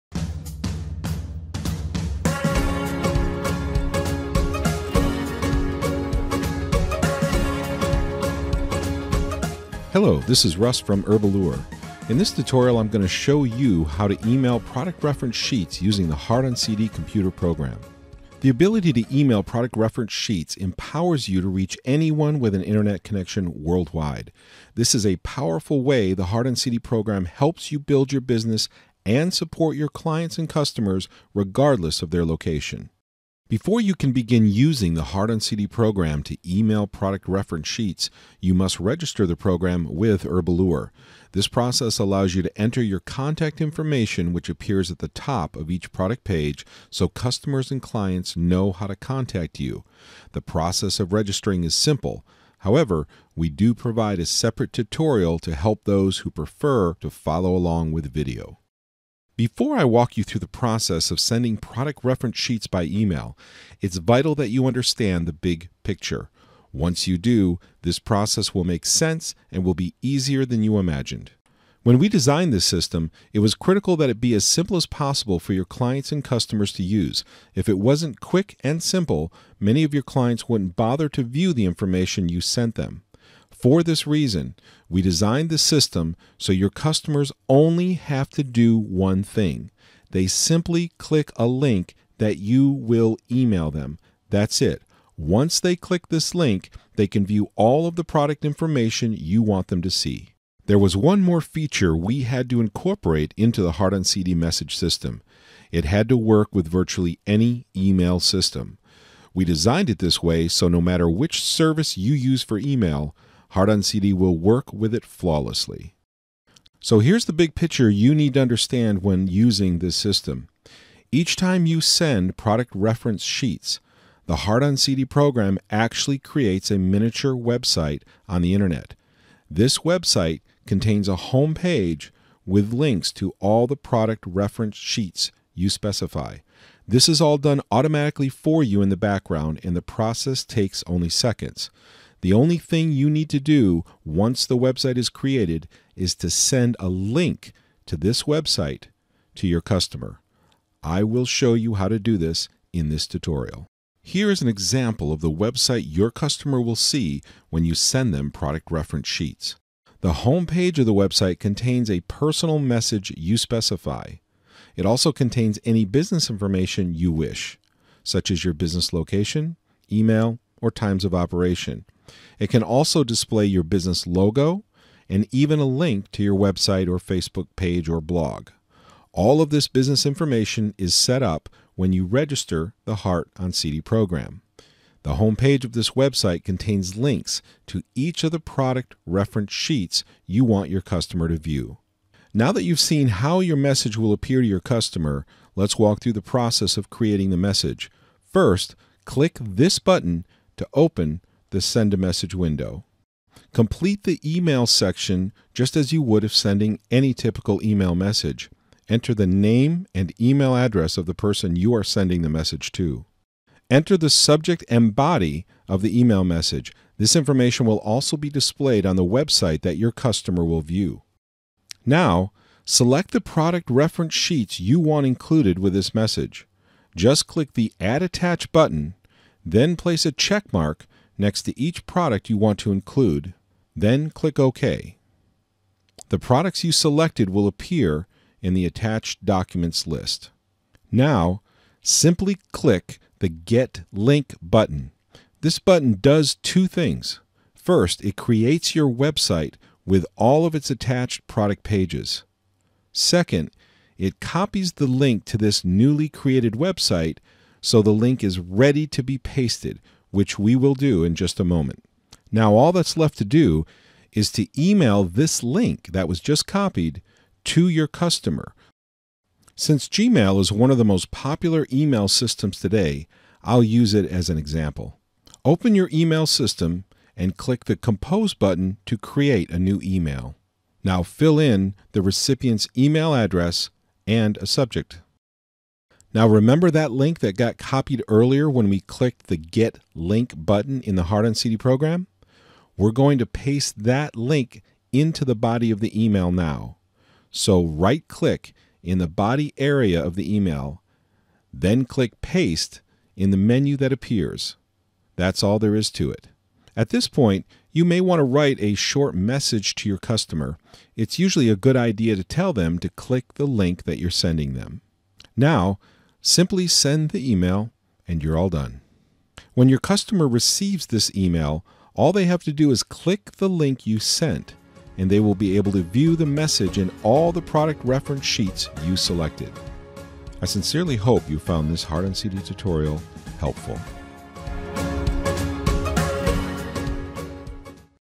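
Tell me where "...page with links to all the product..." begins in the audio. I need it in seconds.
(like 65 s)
131 s.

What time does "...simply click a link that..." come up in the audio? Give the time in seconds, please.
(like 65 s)
90 s.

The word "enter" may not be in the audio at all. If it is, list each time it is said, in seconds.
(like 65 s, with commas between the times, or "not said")
42 s, 208 s, 213 s.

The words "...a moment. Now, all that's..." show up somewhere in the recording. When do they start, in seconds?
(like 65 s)
261 s.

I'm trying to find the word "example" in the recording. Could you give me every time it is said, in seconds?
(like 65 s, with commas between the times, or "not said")
154 s, 274 s.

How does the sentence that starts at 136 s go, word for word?
This is all done automatically for you in the background, and the process takes only seconds.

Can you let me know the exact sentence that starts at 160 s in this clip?
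The home page of the website contains a personal message you specify.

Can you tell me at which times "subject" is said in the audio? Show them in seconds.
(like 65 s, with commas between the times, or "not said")
214 s, 284 s.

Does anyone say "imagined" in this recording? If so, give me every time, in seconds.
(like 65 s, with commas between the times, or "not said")
70 s.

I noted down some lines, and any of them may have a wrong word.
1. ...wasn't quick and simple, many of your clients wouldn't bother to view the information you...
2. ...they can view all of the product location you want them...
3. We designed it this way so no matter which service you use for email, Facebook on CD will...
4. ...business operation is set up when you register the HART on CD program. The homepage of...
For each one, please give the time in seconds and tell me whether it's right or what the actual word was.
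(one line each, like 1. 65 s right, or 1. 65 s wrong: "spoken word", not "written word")
1. 77 s right
2. 96 s wrong: "information", not "location"
3. 109 s wrong: "HART", not "Facebook"
4. 179 s wrong: "information", not "operation".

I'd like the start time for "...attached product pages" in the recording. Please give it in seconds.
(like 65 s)
250 s.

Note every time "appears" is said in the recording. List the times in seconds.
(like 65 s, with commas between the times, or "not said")
44 s, 194 s, 237 s, 303 s.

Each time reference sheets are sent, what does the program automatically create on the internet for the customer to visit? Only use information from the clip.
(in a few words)
A miniature website.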